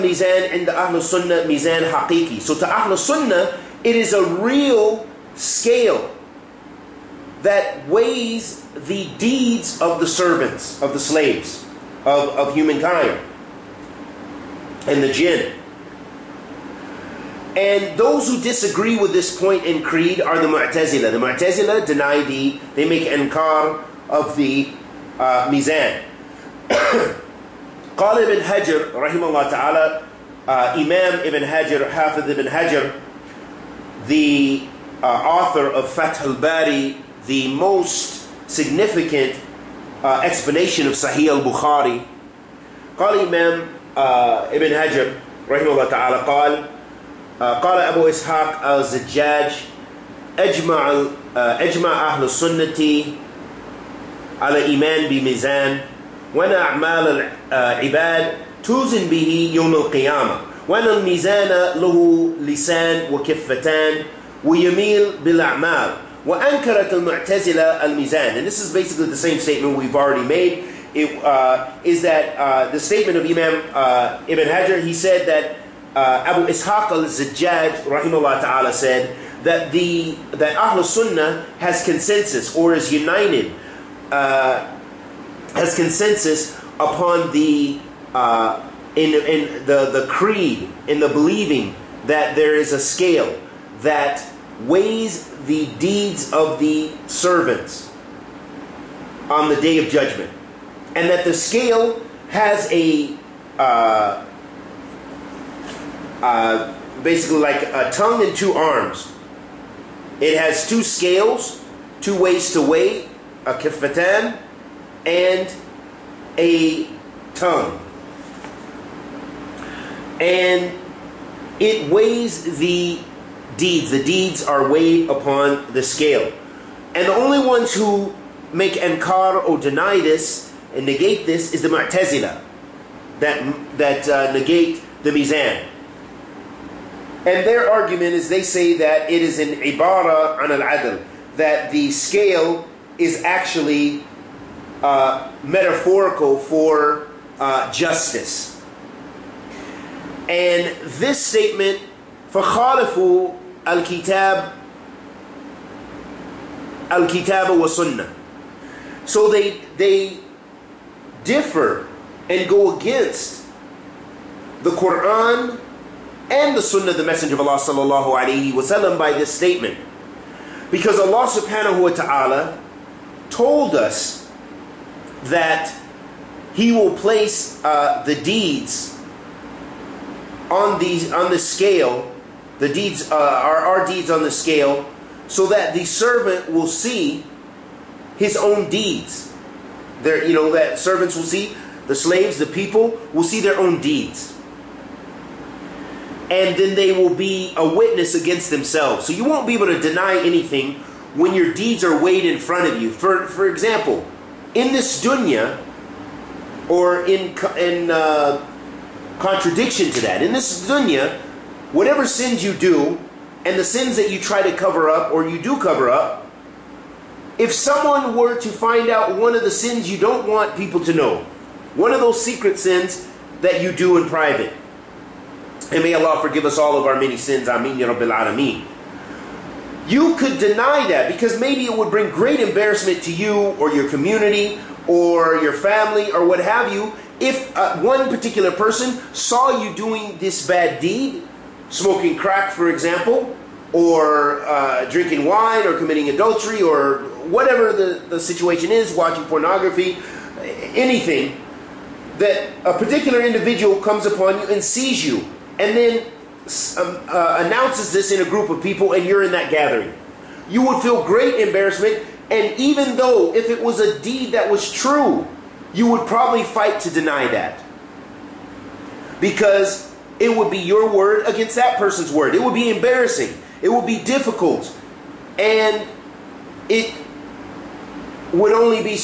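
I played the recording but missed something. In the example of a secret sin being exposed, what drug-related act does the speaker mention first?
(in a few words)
Smoking crack.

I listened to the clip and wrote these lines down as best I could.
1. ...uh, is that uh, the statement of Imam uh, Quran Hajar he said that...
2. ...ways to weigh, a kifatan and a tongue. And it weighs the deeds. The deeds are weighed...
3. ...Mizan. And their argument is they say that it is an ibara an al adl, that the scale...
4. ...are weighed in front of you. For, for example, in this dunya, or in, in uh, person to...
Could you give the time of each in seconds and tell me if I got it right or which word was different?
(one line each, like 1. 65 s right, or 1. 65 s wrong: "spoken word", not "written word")
1. 71 s wrong: "Ibn", not "Quran"
2. 112 s right
3. 135 s right
4. 201 s wrong: "contradiction", not "person".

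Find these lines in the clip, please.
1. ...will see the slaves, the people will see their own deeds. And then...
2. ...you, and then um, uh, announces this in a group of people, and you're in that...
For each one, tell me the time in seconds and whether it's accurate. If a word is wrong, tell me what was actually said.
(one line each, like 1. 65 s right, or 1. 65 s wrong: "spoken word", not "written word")
1. 191 s right
2. 255 s right.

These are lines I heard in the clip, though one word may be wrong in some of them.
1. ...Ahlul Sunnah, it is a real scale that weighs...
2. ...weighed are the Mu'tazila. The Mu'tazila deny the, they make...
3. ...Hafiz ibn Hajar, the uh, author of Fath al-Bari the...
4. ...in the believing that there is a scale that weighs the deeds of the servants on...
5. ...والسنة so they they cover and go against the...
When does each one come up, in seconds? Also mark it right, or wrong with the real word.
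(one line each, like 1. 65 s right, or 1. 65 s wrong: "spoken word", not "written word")
1. 2 s right
2. 19 s wrong: "creed", not "weighed"
3. 31 s right
4. 90 s right
5. 157 s wrong: "differ", not "cover".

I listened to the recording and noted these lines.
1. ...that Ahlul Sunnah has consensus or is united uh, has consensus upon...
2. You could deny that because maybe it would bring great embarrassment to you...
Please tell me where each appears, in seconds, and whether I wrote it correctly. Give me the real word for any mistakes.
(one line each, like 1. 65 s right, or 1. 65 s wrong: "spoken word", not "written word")
1. 80 s right
2. 229 s right.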